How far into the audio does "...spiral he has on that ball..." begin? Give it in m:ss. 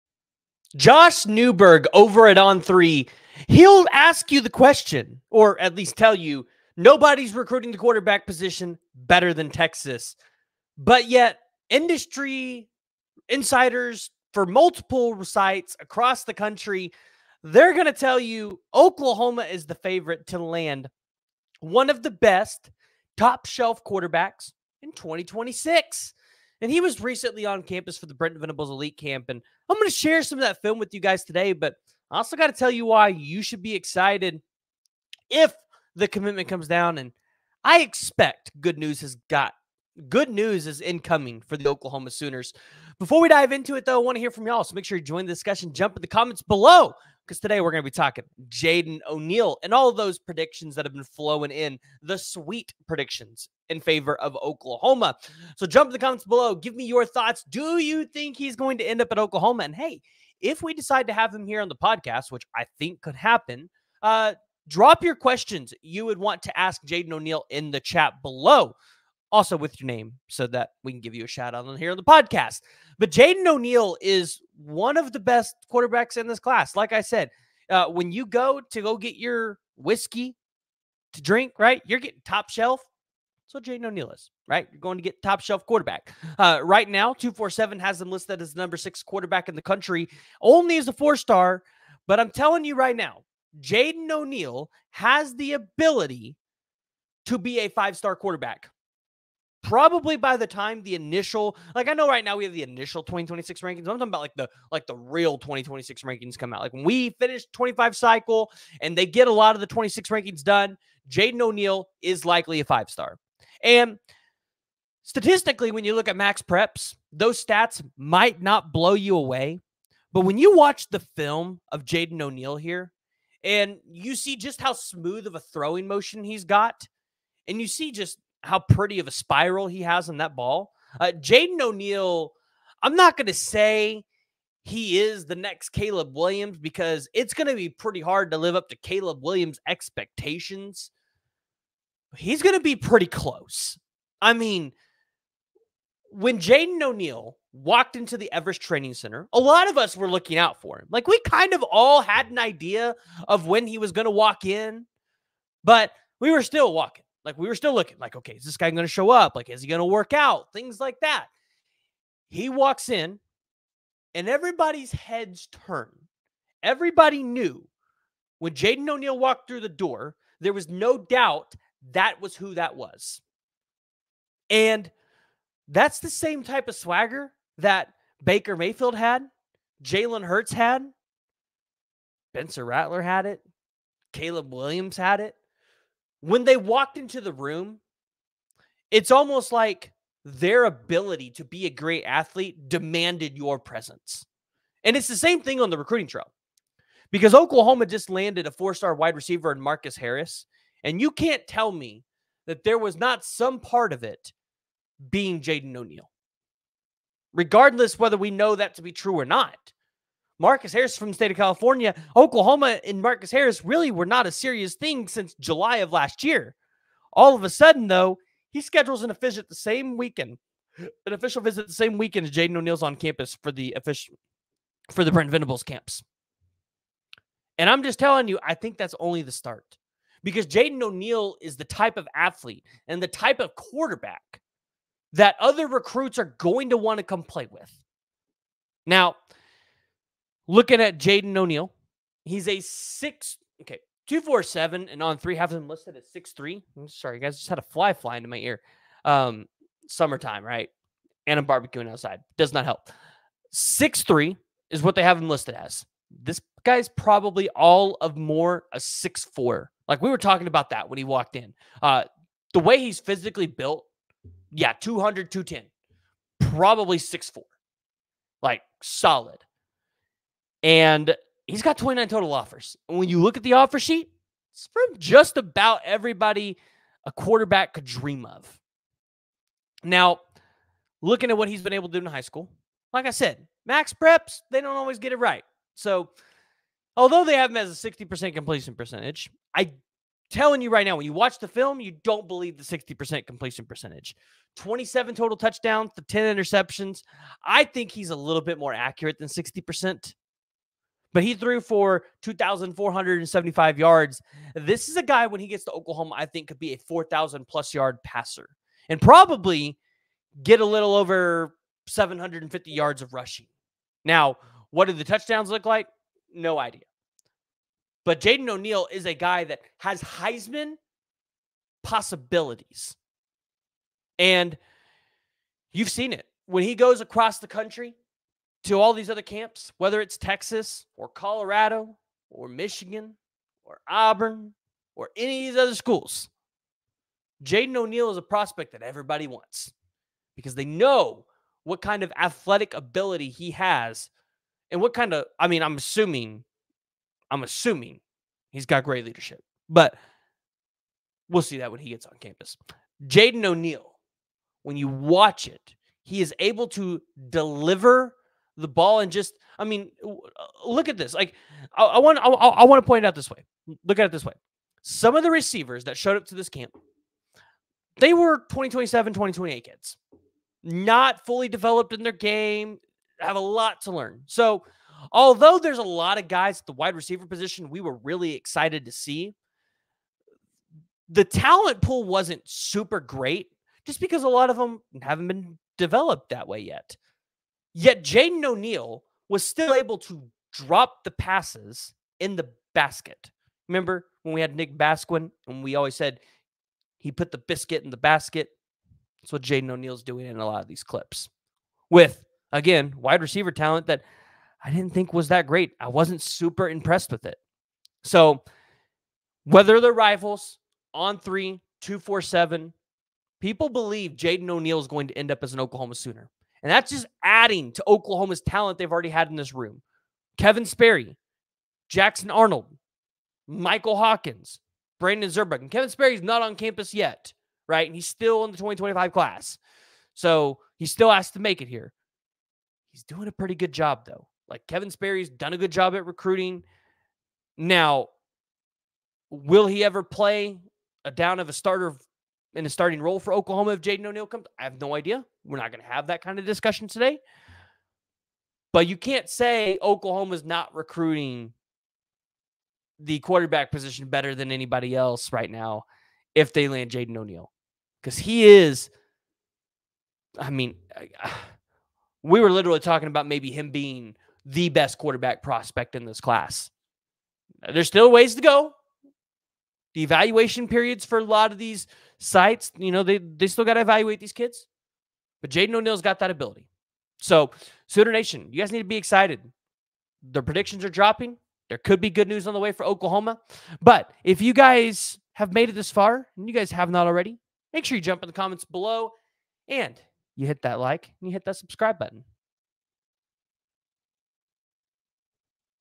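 2:09.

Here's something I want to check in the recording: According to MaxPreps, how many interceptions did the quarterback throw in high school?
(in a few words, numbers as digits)
10.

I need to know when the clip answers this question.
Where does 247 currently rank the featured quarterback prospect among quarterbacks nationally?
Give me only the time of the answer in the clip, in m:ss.
1:28.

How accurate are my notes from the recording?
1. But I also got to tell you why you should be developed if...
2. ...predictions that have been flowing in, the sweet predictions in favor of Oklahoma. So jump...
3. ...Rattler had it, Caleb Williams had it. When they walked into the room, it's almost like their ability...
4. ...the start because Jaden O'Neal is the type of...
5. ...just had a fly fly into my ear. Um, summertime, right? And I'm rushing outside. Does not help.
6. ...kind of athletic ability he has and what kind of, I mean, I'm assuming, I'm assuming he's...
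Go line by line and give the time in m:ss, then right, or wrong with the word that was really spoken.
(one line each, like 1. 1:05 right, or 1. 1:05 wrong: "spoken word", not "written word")
1. 0:31 wrong: "excited", not "developed"
2. 0:50 right
3. 3:02 right
4. 3:49 right
5. 4:07 wrong: "barbecuing", not "rushing"
6. 5:41 right.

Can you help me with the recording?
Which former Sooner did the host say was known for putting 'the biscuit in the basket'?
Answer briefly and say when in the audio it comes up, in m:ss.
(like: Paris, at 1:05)
Nick Basquine, at 6:34.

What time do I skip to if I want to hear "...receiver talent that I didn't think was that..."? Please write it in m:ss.
6:43.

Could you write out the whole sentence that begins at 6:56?
And that's just adding to Oklahoma's talent they've already had in this room.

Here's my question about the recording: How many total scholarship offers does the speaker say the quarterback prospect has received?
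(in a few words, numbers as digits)
29.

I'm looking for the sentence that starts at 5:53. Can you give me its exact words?
Jaden O'Neal, when you watch it, he is able to deliver the ball and just, I mean, uh, look at this.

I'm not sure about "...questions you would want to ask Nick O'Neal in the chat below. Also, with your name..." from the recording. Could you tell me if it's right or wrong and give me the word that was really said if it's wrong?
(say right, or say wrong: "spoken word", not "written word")
wrong: "Jaden", not "Nick".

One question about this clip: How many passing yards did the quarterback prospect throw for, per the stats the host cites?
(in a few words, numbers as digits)
2,475.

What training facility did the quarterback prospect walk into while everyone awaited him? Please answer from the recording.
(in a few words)
Everest Training Center.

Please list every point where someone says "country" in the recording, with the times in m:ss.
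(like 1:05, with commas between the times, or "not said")
0:16, 1:29, 5:27.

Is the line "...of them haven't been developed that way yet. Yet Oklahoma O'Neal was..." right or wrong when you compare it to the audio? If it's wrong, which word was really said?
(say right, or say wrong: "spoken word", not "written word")
wrong: "Jaden", not "Oklahoma".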